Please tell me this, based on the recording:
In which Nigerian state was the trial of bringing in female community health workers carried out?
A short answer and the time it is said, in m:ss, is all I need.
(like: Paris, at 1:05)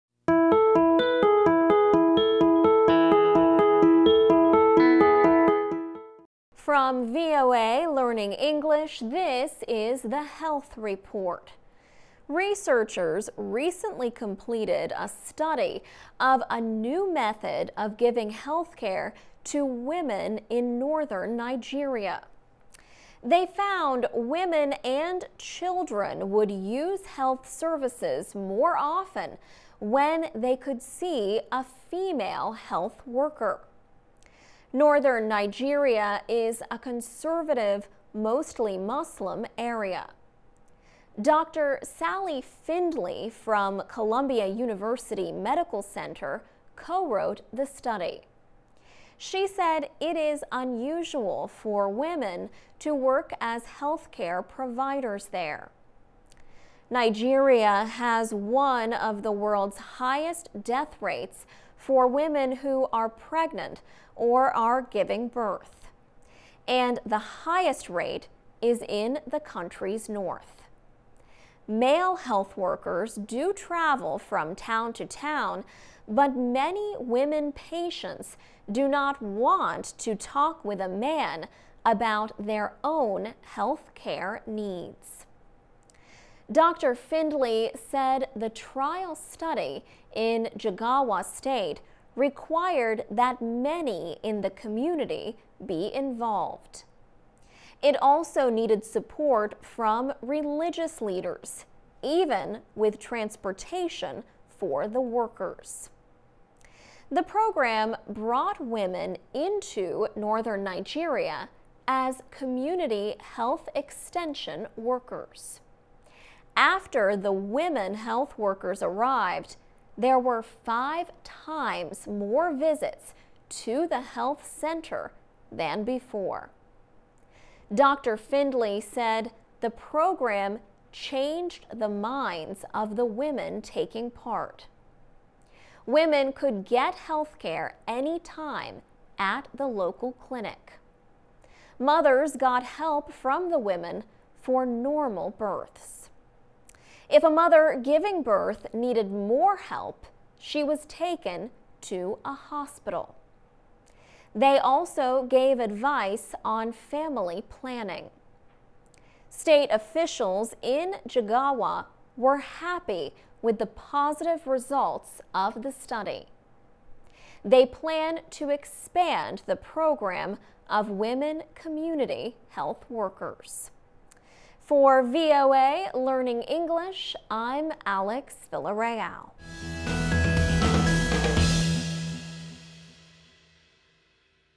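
Jigawa State, at 1:30.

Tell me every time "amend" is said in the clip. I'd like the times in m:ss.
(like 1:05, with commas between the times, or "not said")
not said.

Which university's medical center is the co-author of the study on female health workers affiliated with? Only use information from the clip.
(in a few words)
Columbia University.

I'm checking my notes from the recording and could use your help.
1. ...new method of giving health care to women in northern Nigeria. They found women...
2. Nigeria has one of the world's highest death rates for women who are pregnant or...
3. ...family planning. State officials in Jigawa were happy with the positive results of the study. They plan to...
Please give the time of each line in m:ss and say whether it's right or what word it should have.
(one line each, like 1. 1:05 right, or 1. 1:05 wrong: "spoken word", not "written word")
1. 0:16 right
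2. 0:56 right
3. 2:36 right.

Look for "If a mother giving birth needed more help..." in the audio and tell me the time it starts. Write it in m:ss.
2:27.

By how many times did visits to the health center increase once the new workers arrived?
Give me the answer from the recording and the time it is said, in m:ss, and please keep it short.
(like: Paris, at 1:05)
5, at 2:00.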